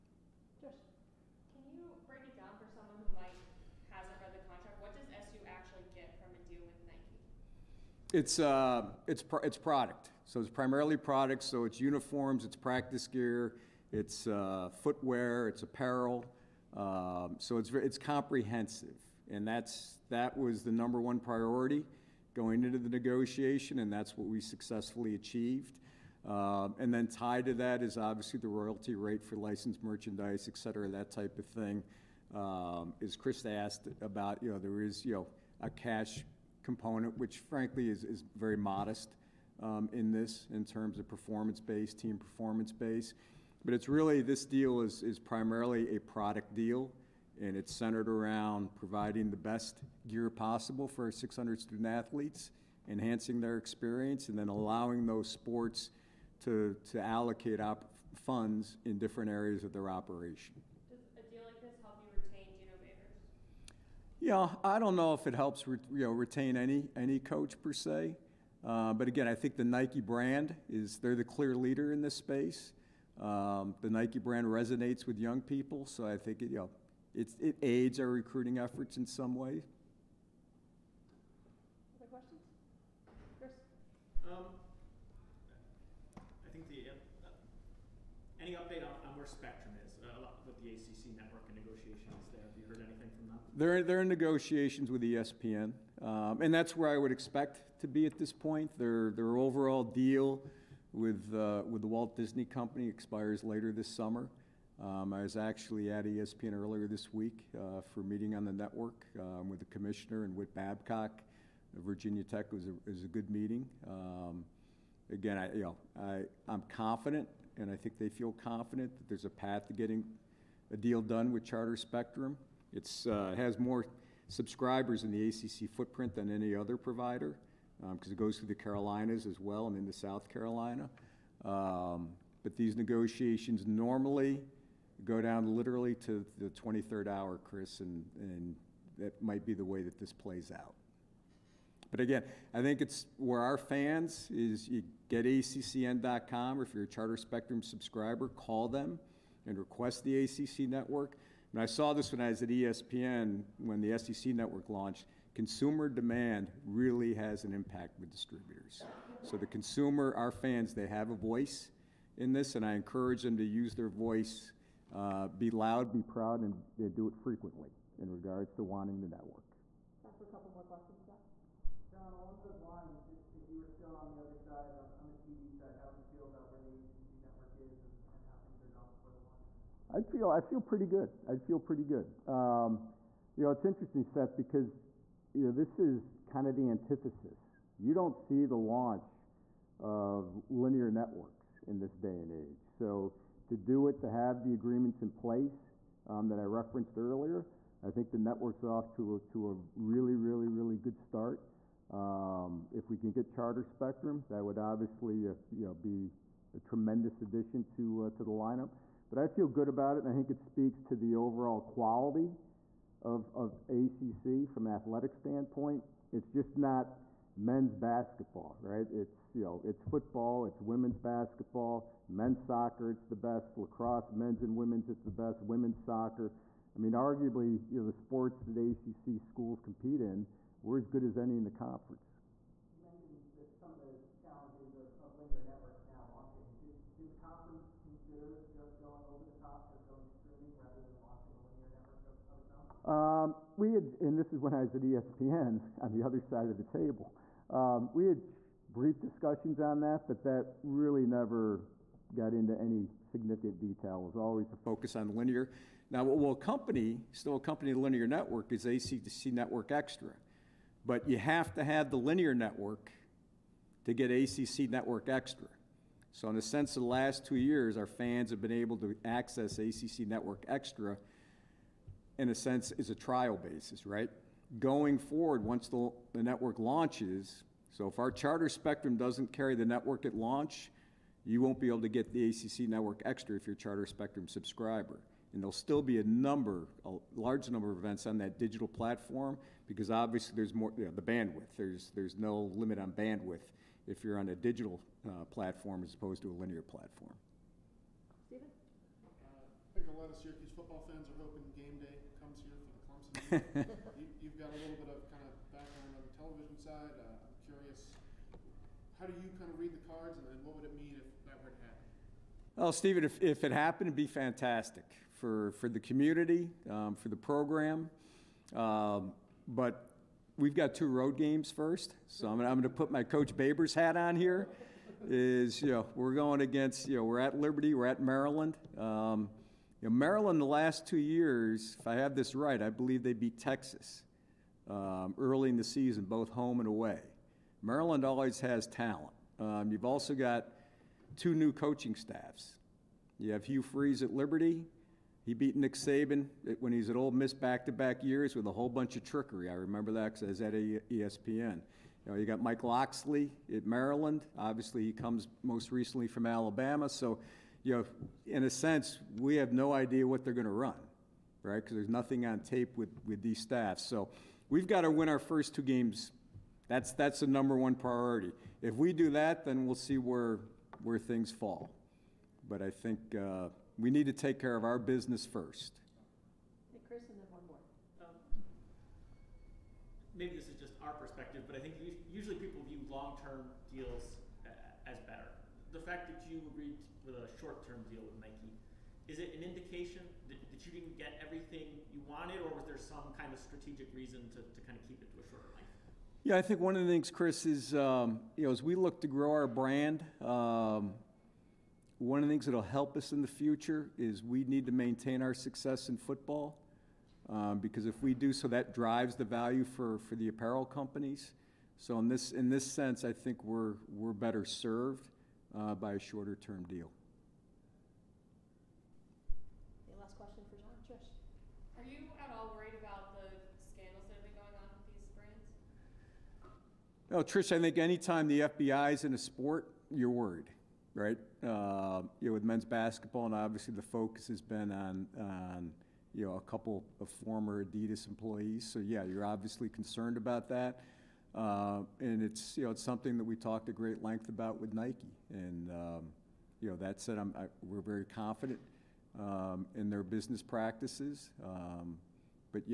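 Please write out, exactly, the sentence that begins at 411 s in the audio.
So in this in this sense, I think we're we're better served uh, by a shorter term deal.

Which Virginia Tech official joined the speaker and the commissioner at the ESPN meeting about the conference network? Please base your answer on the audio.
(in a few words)
Whit Babcock.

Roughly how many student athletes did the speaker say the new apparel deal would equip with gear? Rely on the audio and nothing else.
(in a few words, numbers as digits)
600.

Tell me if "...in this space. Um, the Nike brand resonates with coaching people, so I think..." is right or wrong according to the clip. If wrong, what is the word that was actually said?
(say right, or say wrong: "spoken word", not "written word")
wrong: "young", not "coaching".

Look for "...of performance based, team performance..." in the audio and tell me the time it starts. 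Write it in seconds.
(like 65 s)
40 s.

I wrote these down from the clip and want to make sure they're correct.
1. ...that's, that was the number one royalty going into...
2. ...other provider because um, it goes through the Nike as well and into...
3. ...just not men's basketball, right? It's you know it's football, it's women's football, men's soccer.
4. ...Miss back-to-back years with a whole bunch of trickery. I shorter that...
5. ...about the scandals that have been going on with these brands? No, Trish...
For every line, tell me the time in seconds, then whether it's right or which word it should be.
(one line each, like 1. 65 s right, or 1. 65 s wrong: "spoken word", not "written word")
1. 19 s wrong: "priority", not "royalty"
2. 126 s wrong: "Carolinas", not "Nike"
3. 216 s wrong: "basketball", not "football"
4. 347 s wrong: "remember", not "shorter"
5. 422 s right.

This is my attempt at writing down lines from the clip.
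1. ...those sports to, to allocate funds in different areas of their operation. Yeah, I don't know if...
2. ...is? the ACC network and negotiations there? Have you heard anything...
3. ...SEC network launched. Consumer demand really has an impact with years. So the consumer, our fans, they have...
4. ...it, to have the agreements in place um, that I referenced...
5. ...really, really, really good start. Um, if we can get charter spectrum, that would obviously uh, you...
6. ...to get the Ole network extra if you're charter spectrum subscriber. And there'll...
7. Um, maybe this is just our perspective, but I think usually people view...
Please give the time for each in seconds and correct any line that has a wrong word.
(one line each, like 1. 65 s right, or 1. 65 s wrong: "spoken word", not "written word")
1. 55 s right
2. 89 s right
3. 153 s wrong: "distributors", not "years"
4. 193 s right
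5. 199 s right
6. 281 s wrong: "ACC", not "Ole"
7. 378 s right.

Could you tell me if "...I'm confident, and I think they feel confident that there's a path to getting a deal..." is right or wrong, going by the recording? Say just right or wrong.
right.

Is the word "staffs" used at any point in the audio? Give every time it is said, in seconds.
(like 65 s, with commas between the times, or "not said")
341 s, 363 s.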